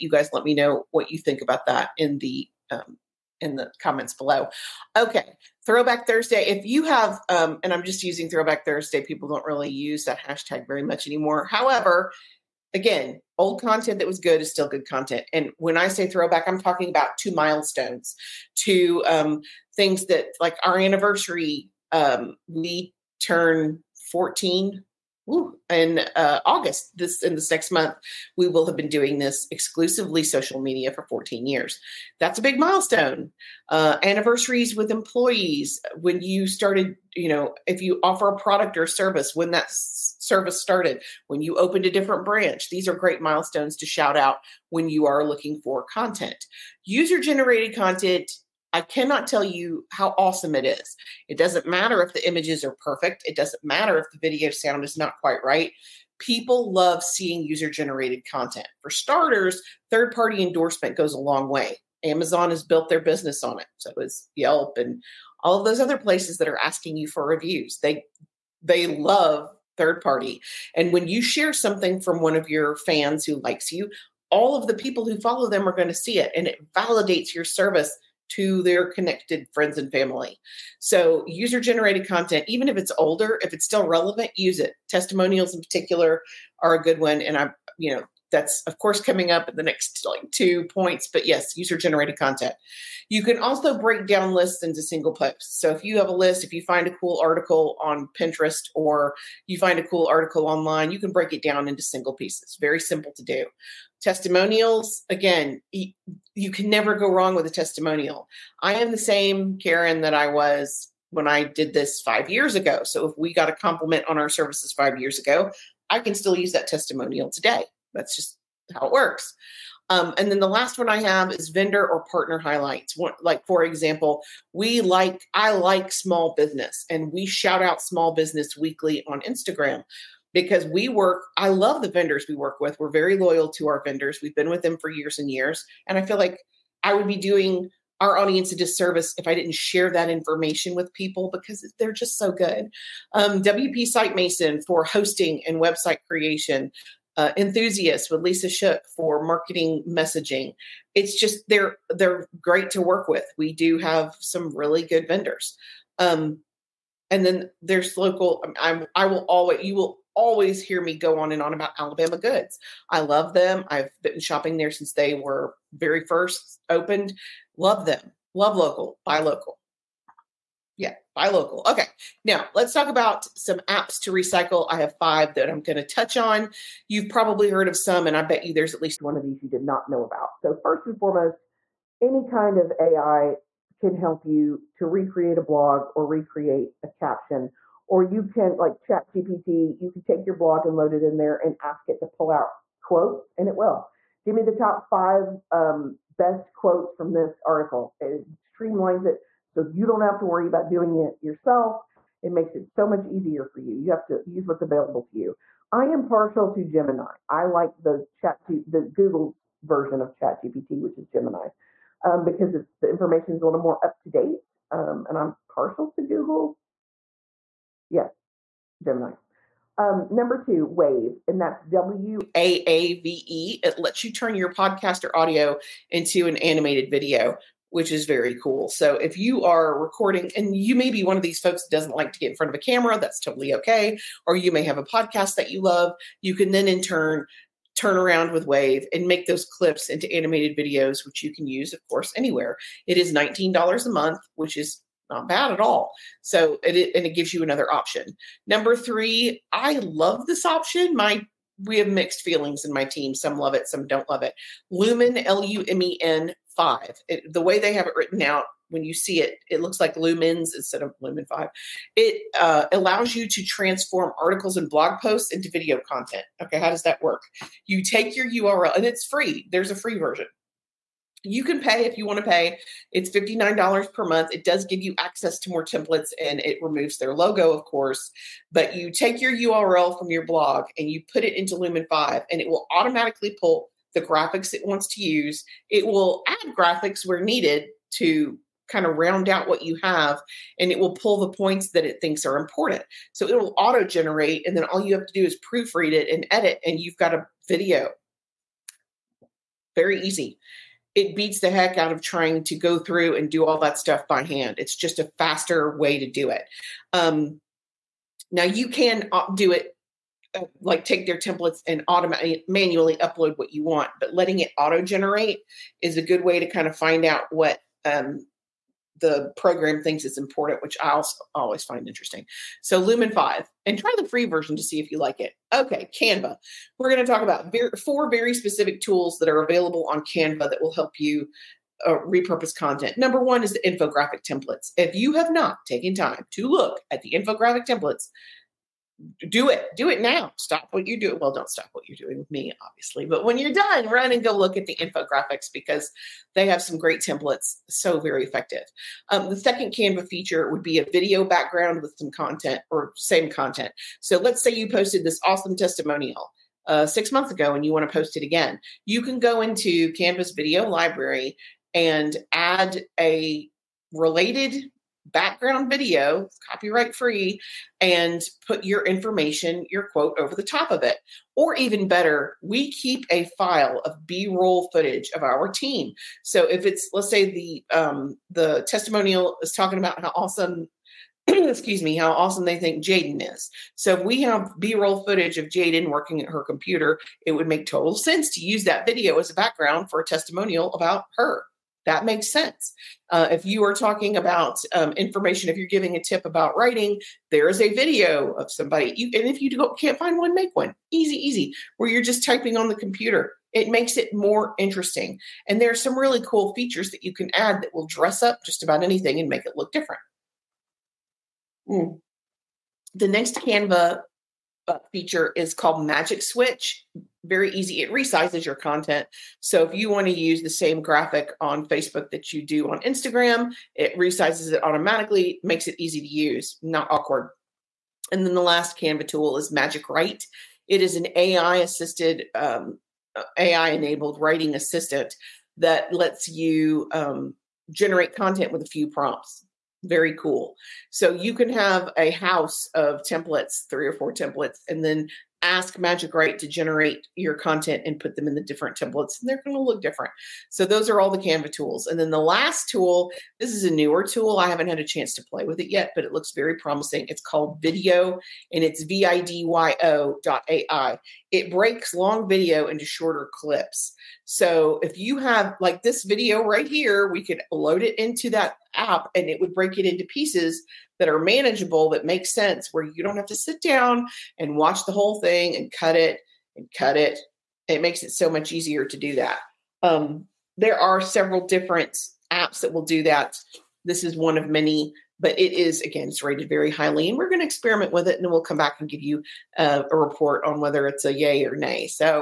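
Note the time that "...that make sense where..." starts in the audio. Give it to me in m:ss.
7:51.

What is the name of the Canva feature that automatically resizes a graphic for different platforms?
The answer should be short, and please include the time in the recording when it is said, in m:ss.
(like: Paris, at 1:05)
Magic Switch, at 6:55.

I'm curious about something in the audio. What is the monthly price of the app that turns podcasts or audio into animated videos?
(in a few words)
$19.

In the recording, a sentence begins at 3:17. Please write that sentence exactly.
It streamlines it so you don't have to worry about doing it yourself.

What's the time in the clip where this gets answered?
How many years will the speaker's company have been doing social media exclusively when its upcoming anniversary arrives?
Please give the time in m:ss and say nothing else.
0:31.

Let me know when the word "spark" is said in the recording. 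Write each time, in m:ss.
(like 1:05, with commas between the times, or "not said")
not said.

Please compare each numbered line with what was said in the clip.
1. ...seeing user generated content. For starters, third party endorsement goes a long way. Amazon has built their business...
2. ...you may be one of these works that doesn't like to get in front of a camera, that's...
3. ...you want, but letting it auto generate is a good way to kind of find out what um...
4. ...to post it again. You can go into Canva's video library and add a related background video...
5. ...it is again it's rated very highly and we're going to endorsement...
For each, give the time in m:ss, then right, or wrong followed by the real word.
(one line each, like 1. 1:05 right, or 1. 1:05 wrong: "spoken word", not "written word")
1. 0:57 right
2. 3:50 wrong: "folks", not "works"
3. 5:13 right
4. 5:57 right
5. 8:05 wrong: "experiment", not "endorsement".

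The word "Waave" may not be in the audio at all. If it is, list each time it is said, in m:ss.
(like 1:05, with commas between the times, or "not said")
3:40, 3:58.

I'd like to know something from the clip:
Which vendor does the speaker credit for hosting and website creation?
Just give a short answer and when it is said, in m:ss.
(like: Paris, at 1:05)
WP Site Mason, at 2:23.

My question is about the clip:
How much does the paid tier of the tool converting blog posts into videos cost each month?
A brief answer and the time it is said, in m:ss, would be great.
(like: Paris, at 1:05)
$59, at 4:33.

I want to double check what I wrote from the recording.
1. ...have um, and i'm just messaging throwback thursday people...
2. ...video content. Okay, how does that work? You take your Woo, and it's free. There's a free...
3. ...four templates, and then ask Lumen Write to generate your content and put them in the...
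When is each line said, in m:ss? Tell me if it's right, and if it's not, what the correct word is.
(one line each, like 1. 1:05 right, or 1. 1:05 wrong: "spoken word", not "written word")
1. 0:06 wrong: "using", not "messaging"
2. 4:25 wrong: "URL", not "Woo"
3. 7:23 wrong: "Magic", not "Lumen".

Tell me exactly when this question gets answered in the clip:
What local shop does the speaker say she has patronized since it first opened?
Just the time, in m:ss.
2:41.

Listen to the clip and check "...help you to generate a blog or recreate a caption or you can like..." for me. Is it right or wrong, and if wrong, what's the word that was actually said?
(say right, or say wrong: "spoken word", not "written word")
wrong: "recreate", not "generate".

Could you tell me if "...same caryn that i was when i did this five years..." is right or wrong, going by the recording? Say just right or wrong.
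right.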